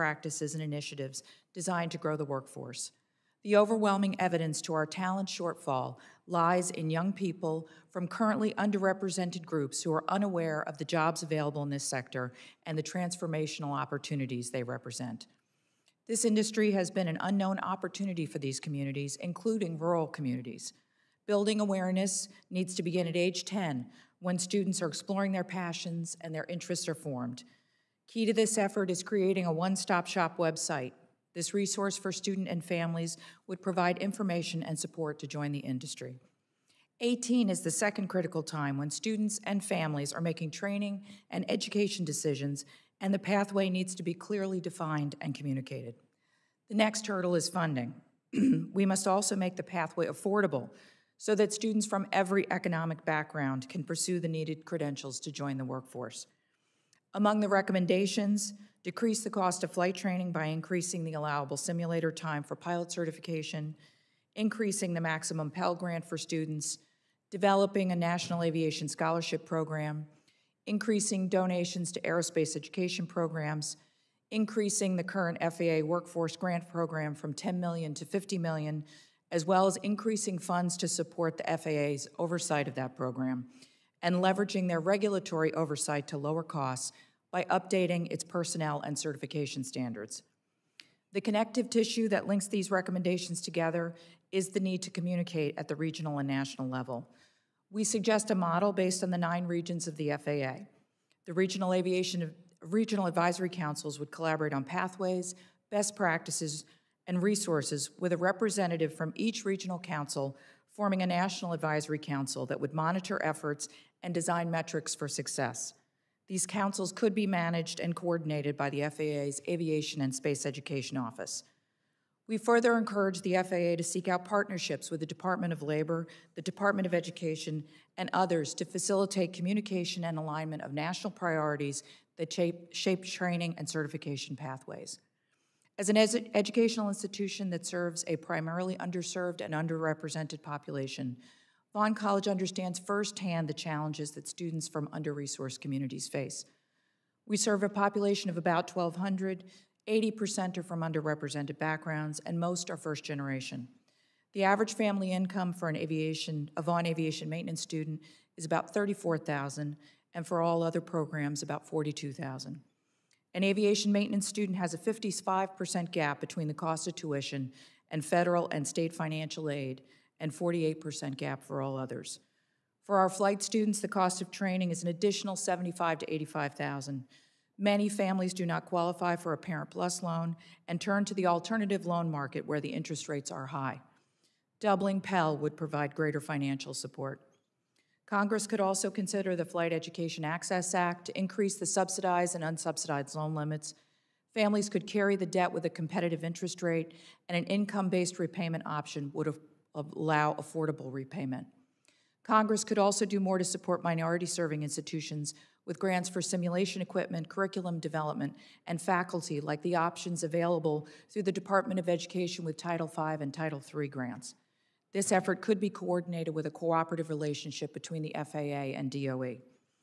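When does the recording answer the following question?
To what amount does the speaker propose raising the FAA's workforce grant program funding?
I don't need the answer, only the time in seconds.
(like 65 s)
78 s.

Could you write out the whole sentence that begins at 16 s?
This industry has been an unknown opportunity for these communities, including rural communities.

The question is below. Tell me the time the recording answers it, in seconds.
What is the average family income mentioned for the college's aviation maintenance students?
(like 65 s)
158 s.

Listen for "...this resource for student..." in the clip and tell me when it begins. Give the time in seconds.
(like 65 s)
31 s.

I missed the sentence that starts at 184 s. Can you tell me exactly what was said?
Doubling Pell would provide greater financial support.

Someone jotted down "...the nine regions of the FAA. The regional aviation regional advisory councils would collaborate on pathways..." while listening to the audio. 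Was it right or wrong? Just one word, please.
right.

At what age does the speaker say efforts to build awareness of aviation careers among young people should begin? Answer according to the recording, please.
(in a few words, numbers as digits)
10.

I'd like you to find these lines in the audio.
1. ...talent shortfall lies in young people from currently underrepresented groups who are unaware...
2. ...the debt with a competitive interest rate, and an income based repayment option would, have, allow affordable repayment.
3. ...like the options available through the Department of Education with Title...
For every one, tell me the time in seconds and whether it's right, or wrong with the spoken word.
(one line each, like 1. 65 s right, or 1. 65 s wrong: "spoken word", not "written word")
1. 4 s right
2. 195 s right
3. 209 s right.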